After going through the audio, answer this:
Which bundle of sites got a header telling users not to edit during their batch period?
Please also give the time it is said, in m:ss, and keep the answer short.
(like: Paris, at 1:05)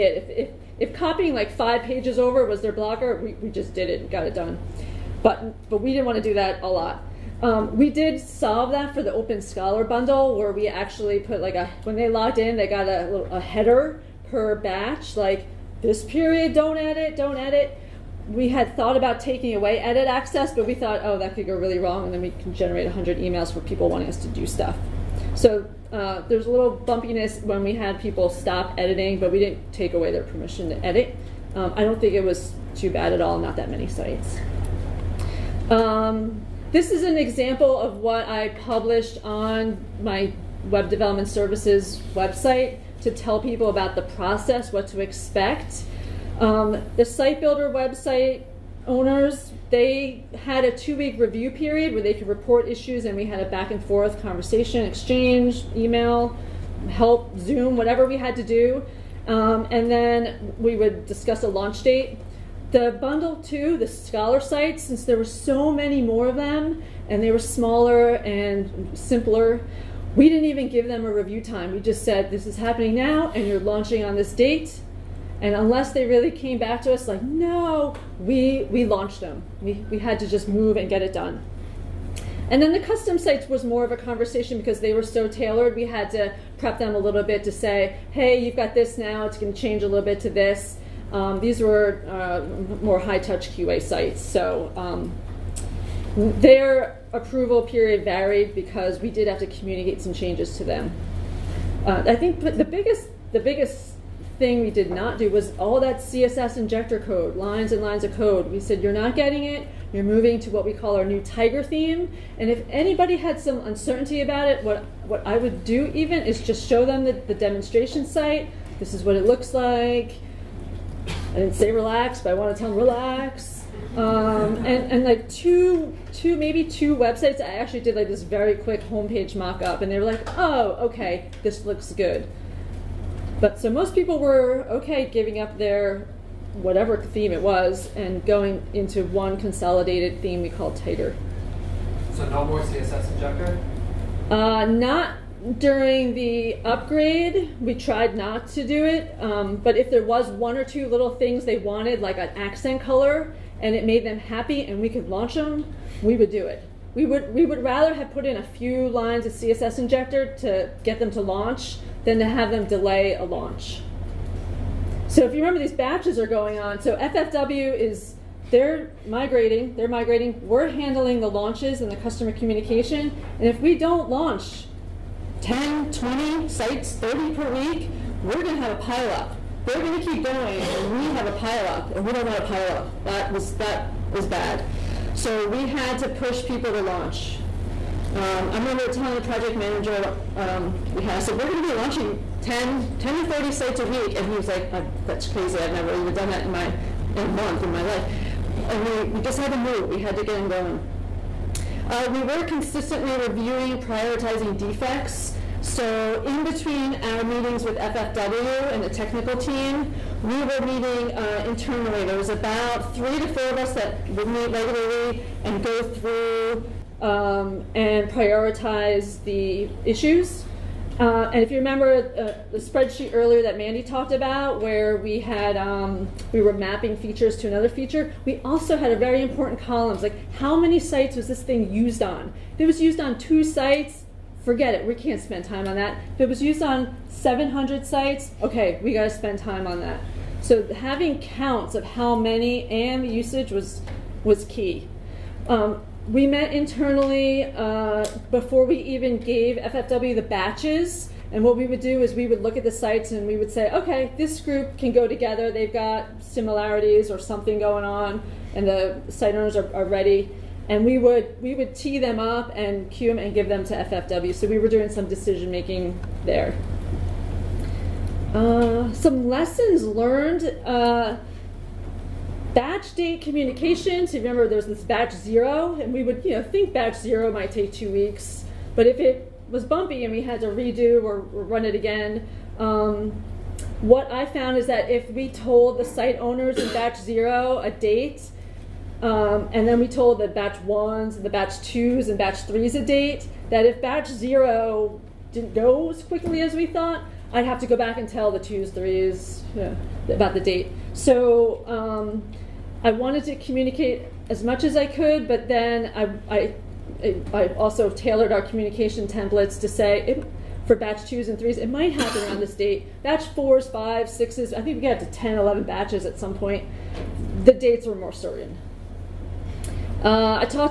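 Open Scholar, at 0:09.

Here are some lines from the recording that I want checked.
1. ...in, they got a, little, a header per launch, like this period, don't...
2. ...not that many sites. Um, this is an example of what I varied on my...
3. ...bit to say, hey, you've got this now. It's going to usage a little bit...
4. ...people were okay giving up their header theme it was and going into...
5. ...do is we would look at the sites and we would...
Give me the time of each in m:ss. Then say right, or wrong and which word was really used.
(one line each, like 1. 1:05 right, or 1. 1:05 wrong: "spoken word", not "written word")
1. 0:12 wrong: "batch", not "launch"
2. 0:33 wrong: "published", not "varied"
3. 1:27 wrong: "change", not "usage"
4. 2:13 wrong: "whatever", not "header"
5. 4:11 right.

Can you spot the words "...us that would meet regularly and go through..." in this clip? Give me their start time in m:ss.
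3:33.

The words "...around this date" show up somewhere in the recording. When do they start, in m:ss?
5:12.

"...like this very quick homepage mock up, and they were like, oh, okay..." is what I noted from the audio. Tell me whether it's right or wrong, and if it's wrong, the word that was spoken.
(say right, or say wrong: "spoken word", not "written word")
right.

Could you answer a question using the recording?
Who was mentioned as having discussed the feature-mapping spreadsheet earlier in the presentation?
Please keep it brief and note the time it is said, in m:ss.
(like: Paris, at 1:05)
Mandee, at 3:43.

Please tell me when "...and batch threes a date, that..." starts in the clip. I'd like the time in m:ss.
4:52.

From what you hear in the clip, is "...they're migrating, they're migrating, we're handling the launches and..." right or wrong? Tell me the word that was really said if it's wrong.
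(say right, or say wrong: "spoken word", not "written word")
right.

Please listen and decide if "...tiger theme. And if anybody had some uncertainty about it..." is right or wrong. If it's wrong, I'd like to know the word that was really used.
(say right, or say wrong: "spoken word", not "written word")
right.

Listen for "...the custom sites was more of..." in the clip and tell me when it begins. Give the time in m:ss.
1:22.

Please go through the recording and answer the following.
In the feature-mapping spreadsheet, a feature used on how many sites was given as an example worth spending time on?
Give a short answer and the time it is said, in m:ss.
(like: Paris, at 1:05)
700, at 3:57.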